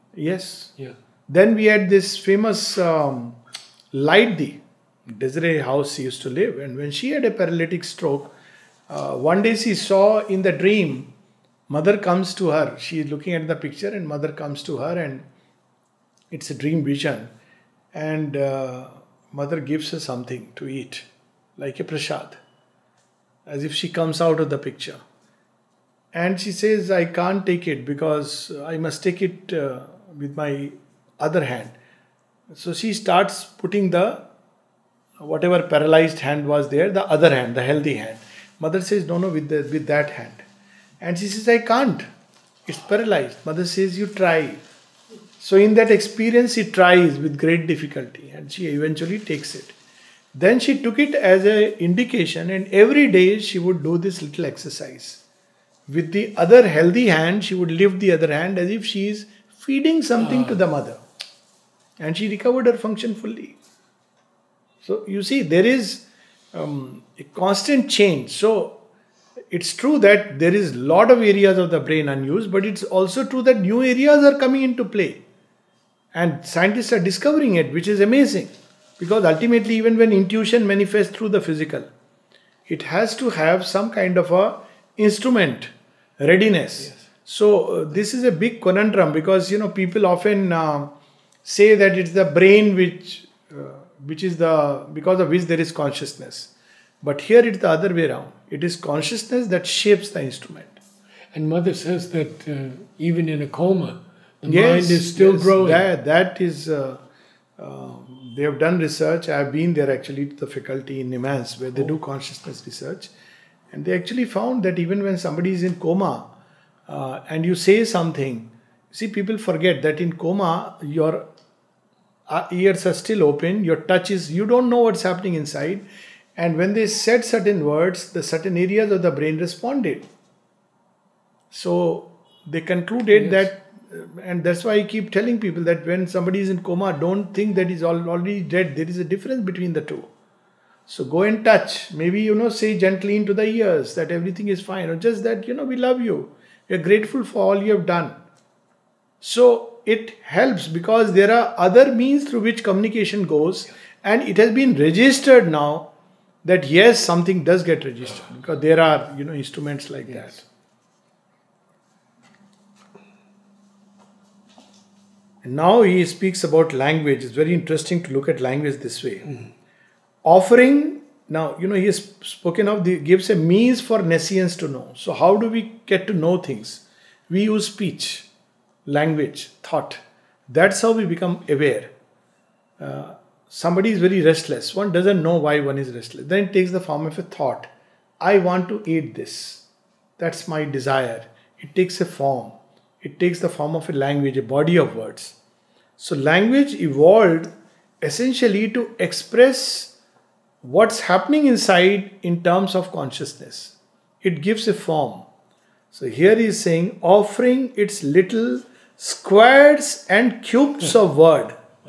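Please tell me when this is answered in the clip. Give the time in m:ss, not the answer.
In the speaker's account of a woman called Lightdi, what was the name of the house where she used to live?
0:05.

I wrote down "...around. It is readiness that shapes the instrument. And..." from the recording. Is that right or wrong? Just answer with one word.
wrong.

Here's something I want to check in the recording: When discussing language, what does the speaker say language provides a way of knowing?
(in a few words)
nescience.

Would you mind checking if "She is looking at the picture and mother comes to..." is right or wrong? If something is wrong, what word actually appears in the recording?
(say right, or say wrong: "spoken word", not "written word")
right.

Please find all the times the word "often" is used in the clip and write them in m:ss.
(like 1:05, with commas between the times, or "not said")
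1:30.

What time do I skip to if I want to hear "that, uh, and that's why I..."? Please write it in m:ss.
2:13.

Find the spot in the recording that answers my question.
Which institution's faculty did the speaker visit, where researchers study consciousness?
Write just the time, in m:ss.
1:51.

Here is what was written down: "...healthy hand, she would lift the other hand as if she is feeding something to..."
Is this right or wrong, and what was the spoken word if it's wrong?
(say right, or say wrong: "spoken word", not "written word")
right.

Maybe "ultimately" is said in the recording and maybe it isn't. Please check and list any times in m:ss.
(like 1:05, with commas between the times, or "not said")
1:19.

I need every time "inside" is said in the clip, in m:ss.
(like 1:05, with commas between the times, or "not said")
2:05, 3:21.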